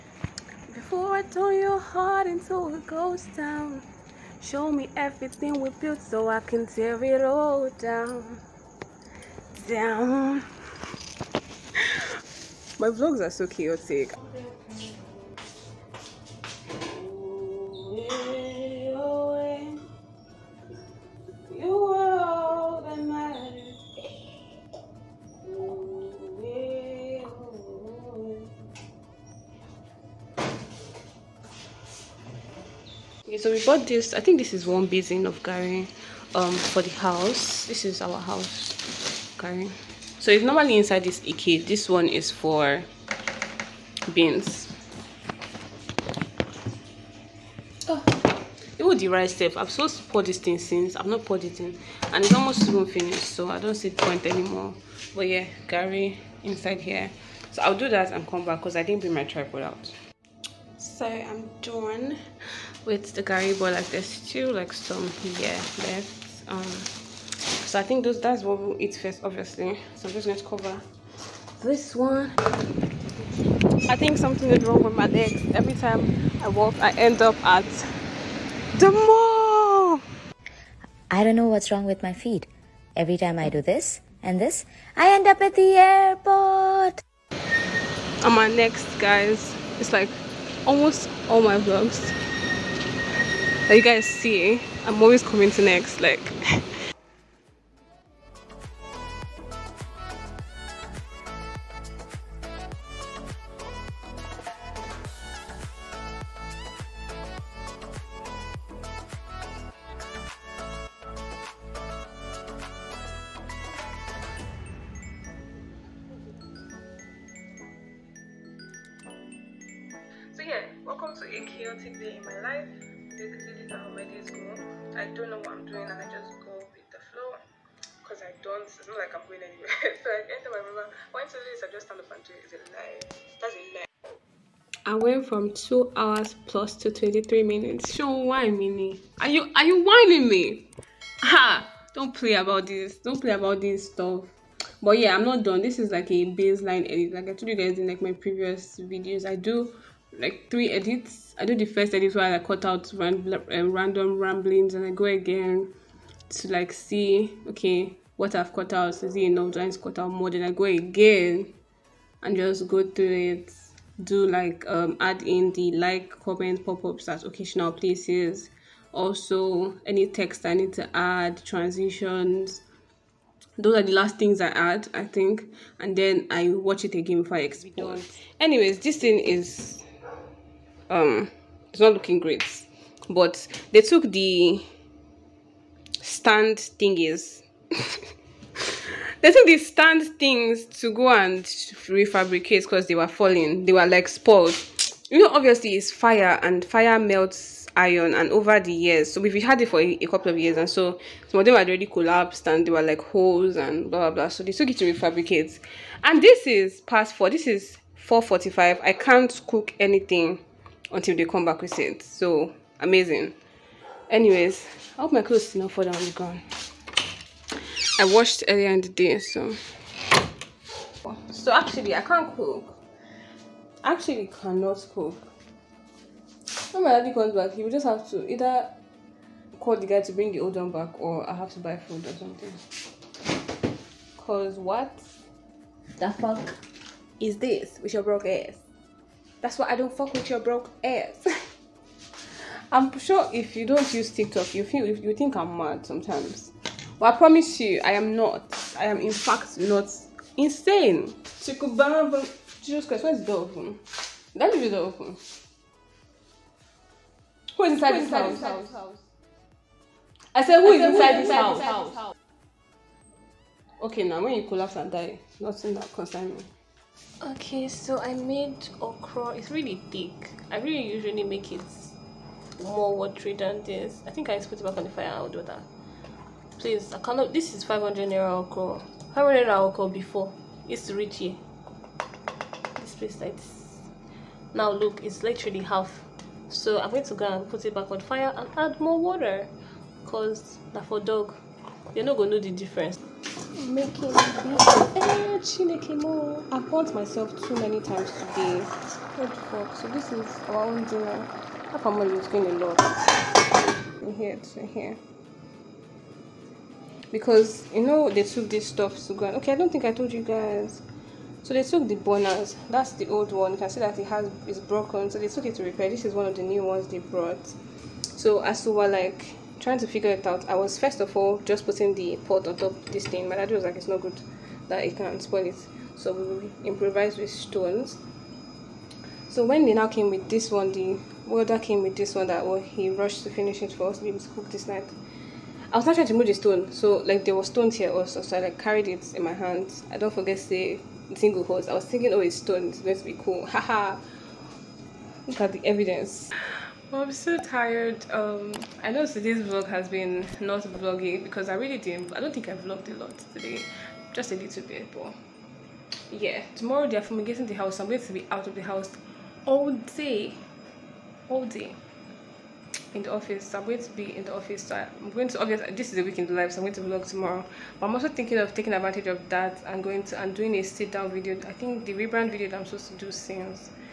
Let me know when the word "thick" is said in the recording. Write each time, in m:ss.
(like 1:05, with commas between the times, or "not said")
4:29.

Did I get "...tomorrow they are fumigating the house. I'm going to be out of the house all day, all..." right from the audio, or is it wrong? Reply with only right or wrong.
right.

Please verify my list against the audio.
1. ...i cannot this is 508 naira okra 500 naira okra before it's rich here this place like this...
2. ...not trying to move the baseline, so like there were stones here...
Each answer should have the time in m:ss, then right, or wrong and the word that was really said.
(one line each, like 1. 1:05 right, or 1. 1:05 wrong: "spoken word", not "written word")
1. 4:36 wrong: "500", not "508"
2. 5:35 wrong: "stone", not "baseline".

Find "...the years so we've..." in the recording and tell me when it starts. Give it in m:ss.
3:18.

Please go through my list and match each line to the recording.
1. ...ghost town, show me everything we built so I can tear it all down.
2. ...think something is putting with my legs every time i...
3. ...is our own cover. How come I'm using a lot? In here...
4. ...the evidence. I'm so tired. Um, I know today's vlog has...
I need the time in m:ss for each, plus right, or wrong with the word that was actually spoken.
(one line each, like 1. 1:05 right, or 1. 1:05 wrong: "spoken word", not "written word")
1. 0:02 right
2. 1:13 wrong: "wrong", not "putting"
3. 5:00 wrong: "dinner", not "cover"
4. 5:45 right.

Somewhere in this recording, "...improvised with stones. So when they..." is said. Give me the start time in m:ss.
5:26.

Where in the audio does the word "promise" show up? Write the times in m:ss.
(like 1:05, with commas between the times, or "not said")
4:07.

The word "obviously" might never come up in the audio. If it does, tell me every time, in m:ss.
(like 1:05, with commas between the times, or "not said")
1:09, 3:15, 6:05.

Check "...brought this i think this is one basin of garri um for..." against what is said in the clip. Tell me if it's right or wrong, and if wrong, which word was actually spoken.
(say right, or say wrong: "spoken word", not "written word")
wrong: "bought", not "brought".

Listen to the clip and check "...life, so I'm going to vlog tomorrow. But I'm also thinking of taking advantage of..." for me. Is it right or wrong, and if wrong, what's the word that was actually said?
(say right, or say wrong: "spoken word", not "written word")
right.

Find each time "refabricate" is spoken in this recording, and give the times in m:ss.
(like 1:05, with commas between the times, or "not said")
3:11, 3:24.